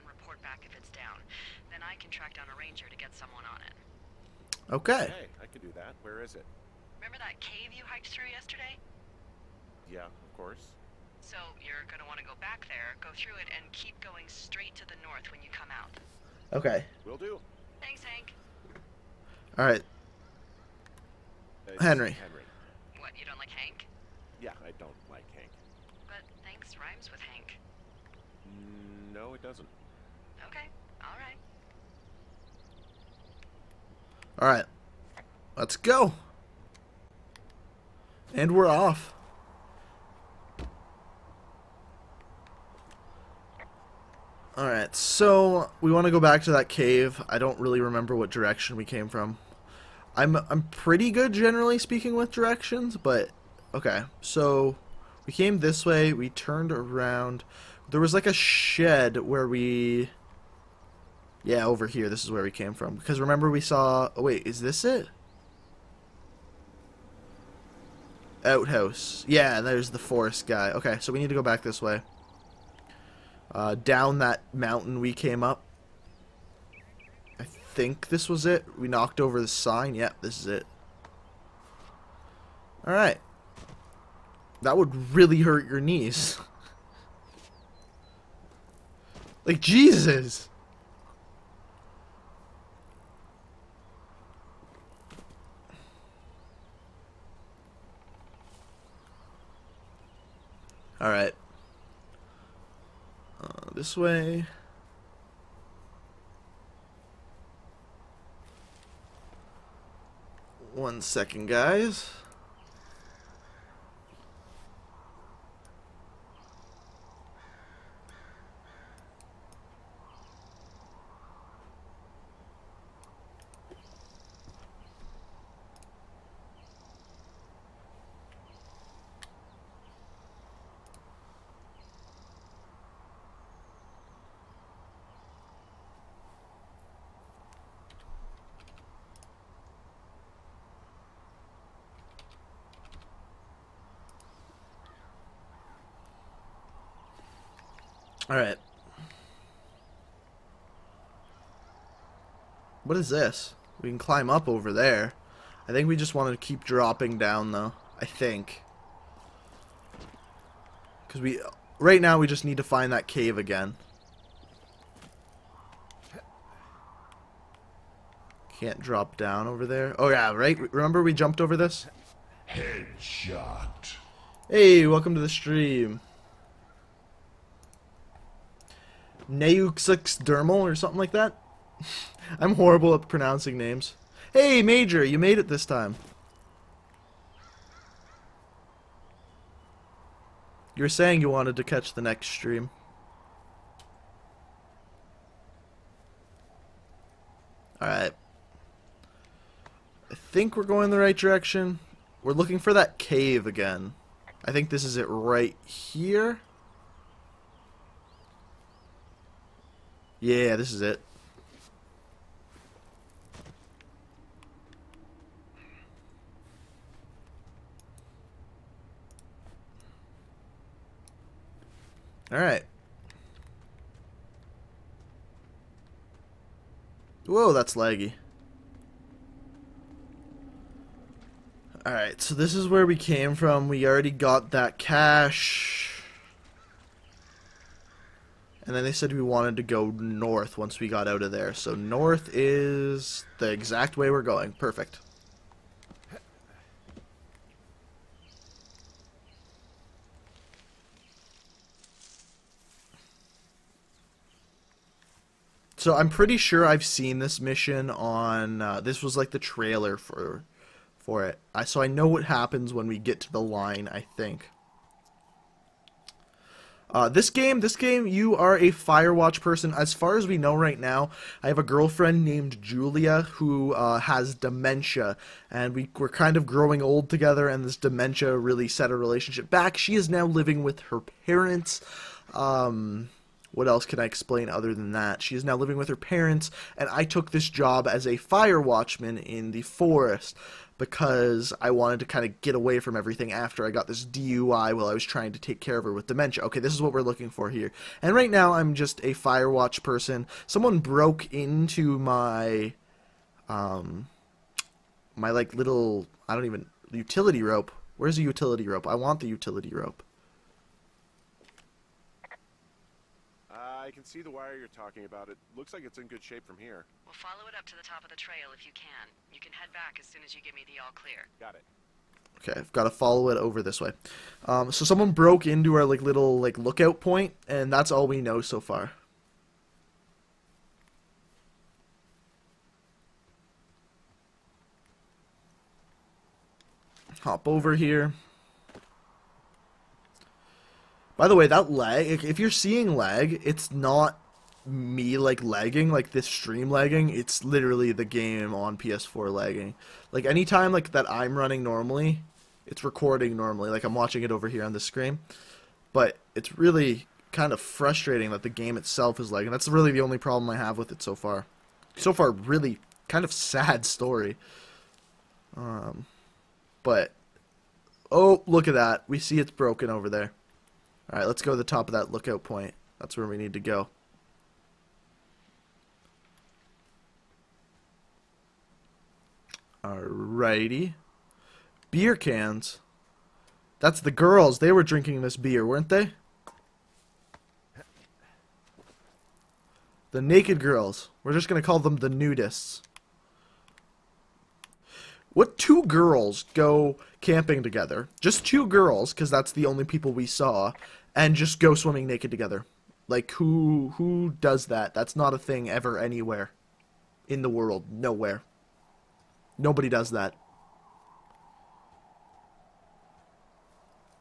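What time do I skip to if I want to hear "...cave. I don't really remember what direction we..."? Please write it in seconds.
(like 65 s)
46 s.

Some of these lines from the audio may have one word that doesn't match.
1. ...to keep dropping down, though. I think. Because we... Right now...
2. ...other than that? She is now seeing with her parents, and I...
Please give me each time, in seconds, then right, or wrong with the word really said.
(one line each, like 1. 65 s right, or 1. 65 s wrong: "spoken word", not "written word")
1. 156 s right
2. 284 s wrong: "living", not "seeing".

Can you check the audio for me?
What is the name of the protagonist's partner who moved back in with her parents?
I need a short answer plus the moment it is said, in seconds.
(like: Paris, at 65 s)
Julia, at 272 s.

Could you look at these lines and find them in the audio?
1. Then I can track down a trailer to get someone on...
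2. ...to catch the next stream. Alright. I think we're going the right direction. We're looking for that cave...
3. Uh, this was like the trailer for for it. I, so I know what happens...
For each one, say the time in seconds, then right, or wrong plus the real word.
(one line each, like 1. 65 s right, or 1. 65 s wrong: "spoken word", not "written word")
1. 1 s wrong: "ranger", not "trailer"
2. 191 s right
3. 258 s right.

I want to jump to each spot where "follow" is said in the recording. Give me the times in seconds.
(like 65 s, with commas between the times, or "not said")
317 s, 322 s.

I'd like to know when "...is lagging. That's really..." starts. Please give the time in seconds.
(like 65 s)
359 s.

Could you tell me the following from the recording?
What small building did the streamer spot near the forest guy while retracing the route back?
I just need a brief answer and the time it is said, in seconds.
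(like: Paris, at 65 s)
Outhouse, at 68 s.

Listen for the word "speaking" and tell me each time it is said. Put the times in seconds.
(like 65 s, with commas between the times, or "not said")
51 s.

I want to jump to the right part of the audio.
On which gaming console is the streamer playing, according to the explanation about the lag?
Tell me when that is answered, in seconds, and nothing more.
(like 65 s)
348 s.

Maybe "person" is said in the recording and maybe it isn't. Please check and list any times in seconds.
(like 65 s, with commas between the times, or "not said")
269 s, 299 s.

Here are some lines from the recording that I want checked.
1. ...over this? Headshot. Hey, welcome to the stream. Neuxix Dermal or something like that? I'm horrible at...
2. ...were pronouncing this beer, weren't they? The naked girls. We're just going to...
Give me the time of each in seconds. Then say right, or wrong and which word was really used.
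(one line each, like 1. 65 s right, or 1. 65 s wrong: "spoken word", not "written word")
1. 171 s right
2. 384 s wrong: "drinking", not "pronouncing".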